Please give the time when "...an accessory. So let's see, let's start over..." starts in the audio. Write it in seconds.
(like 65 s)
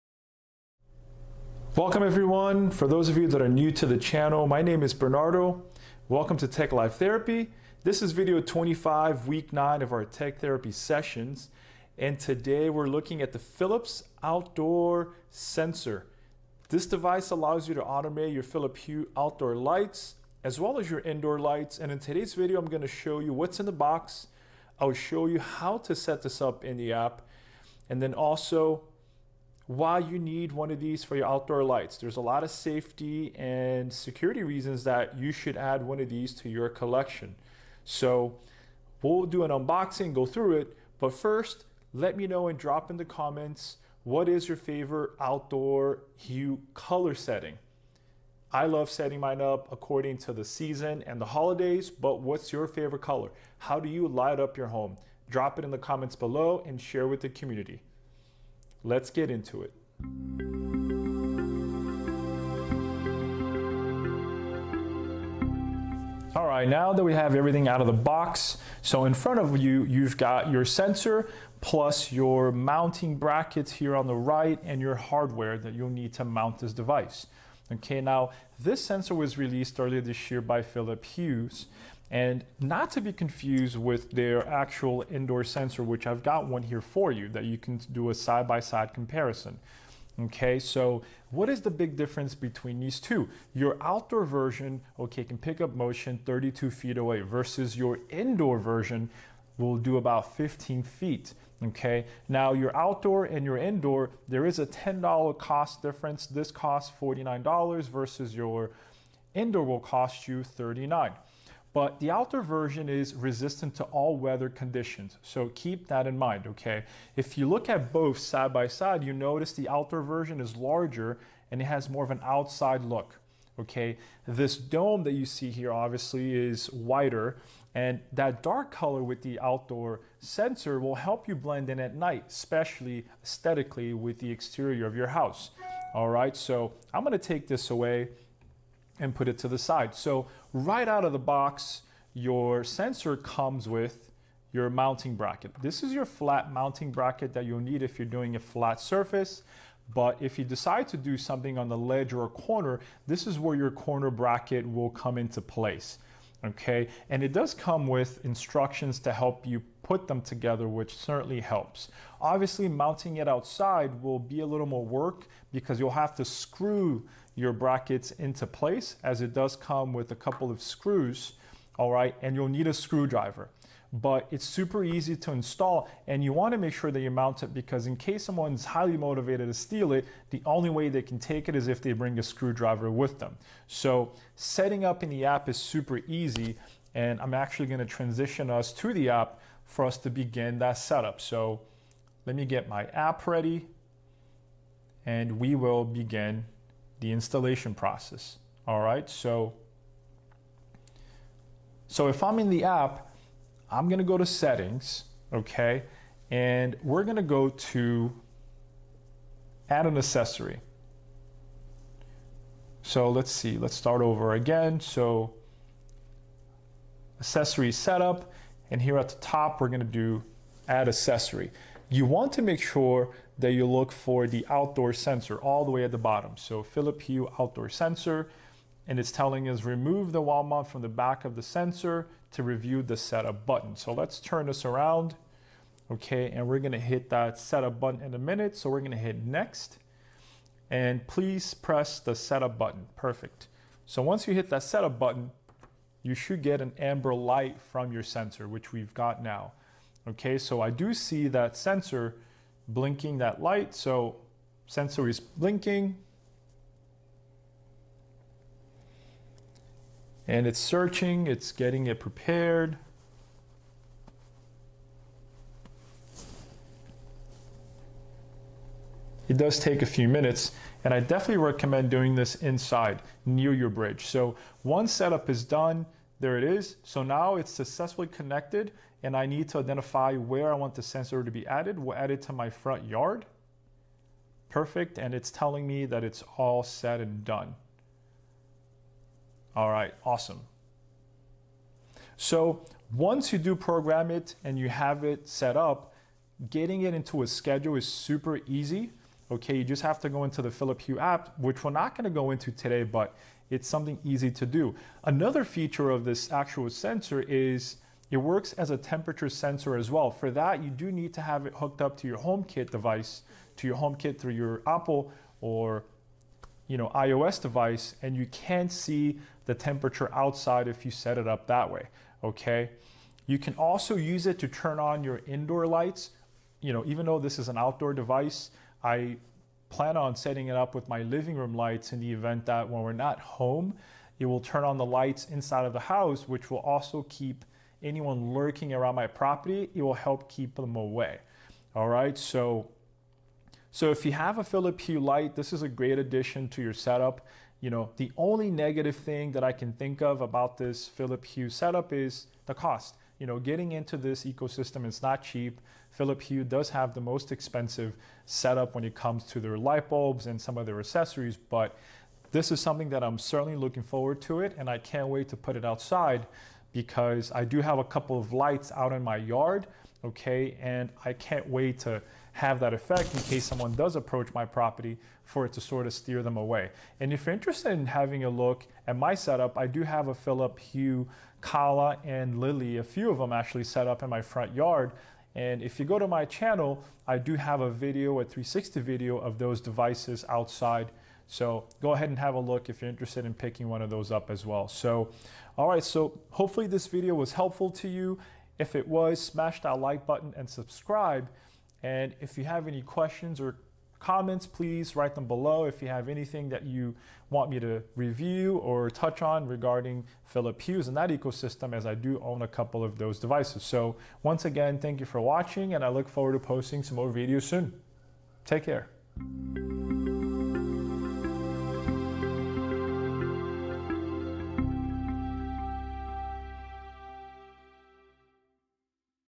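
209 s.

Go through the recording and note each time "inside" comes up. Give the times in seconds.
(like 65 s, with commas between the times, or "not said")
272 s, 335 s.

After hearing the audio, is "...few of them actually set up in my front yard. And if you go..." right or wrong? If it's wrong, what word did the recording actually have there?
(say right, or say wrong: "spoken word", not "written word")
right.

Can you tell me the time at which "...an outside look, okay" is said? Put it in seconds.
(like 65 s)
122 s.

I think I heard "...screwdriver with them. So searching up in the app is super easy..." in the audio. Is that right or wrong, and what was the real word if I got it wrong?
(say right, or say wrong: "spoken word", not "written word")
wrong: "setting", not "searching".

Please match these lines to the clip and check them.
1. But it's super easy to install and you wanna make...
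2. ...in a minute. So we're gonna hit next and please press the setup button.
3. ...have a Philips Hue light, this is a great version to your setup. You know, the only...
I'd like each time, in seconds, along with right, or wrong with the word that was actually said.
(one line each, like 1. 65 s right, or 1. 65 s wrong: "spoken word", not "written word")
1. 173 s right
2. 238 s right
3. 344 s wrong: "addition", not "version".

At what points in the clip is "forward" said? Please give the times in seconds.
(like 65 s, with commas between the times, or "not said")
363 s, 416 s.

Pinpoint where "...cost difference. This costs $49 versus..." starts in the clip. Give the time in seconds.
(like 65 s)
105 s.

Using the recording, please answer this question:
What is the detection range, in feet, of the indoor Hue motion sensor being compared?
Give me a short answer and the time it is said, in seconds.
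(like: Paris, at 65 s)
15 feet, at 100 s.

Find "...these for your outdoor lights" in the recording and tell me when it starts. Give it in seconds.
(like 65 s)
30 s.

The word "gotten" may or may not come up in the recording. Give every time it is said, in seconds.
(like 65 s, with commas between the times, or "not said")
not said.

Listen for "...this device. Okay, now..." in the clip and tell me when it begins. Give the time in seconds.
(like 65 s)
76 s.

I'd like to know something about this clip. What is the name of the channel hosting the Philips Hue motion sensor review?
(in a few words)
Tech Life Therapy.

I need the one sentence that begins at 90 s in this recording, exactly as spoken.
Okay, so what is the big difference between these two?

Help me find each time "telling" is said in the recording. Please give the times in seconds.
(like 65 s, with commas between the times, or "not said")
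229 s, 285 s.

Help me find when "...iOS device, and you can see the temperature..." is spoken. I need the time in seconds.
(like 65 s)
316 s.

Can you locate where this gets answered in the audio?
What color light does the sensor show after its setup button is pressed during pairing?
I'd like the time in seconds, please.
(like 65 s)
246 s.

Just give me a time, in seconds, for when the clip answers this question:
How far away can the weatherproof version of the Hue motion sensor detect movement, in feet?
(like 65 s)
96 s.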